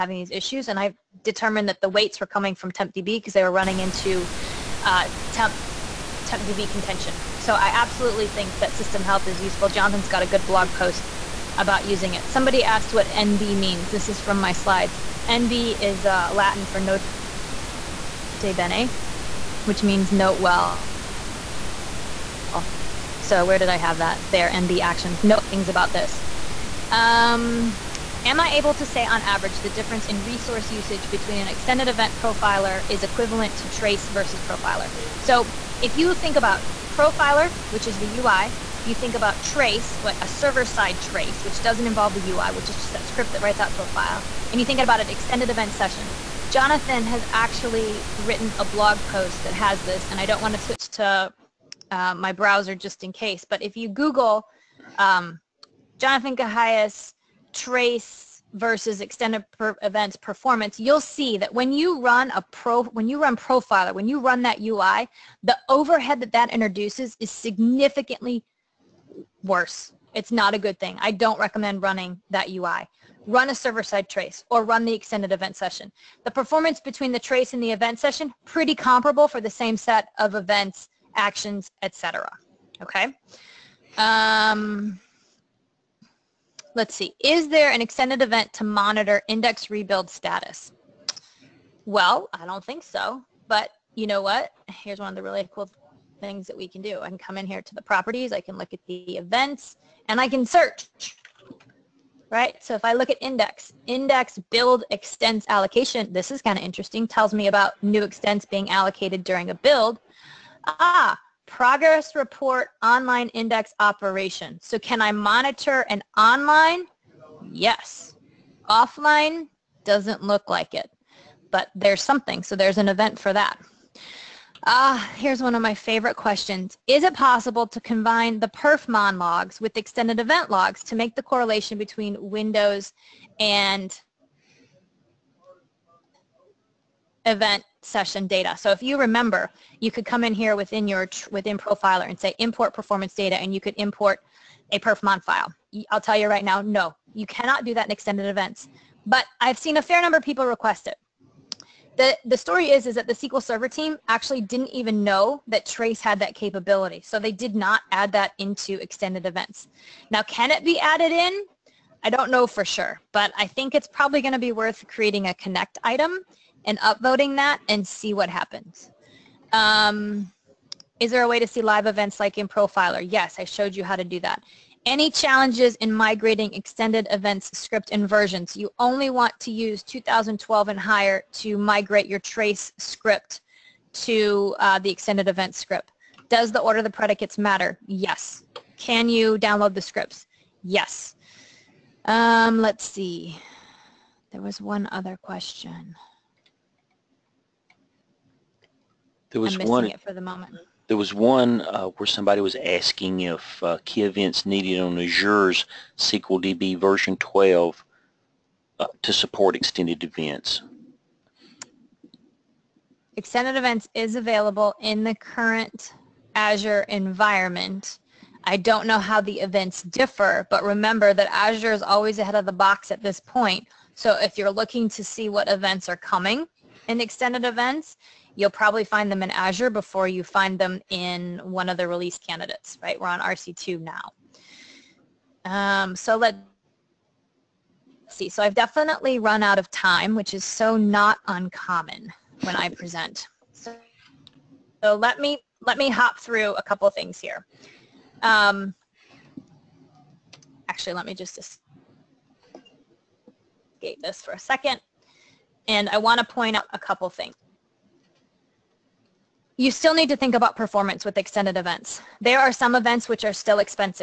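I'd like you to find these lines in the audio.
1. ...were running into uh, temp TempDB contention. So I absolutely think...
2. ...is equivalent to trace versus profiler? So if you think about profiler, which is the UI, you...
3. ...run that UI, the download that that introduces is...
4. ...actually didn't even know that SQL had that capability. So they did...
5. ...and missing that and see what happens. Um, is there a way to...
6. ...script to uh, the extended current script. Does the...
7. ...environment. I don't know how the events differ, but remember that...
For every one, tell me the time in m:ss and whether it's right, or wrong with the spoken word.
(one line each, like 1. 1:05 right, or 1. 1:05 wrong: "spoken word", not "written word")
1. 0:03 right
2. 0:32 right
3. 1:04 wrong: "overhead", not "download"
4. 2:34 wrong: "Trace", not "SQL"
5. 2:46 wrong: "upvoting", not "missing"
6. 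3:02 wrong: "event", not "current"
7. 3:36 right.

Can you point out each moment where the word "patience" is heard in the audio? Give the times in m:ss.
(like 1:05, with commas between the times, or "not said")
not said.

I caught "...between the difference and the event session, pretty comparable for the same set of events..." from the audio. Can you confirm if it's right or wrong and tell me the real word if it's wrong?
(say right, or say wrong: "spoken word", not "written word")
wrong: "trace", not "difference".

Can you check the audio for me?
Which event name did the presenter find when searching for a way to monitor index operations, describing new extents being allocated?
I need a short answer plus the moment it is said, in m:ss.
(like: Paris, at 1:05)
index build extents allocation, at 1:43.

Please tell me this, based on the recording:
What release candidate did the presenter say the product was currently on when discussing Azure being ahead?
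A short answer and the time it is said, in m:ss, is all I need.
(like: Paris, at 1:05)
RC2, at 3:53.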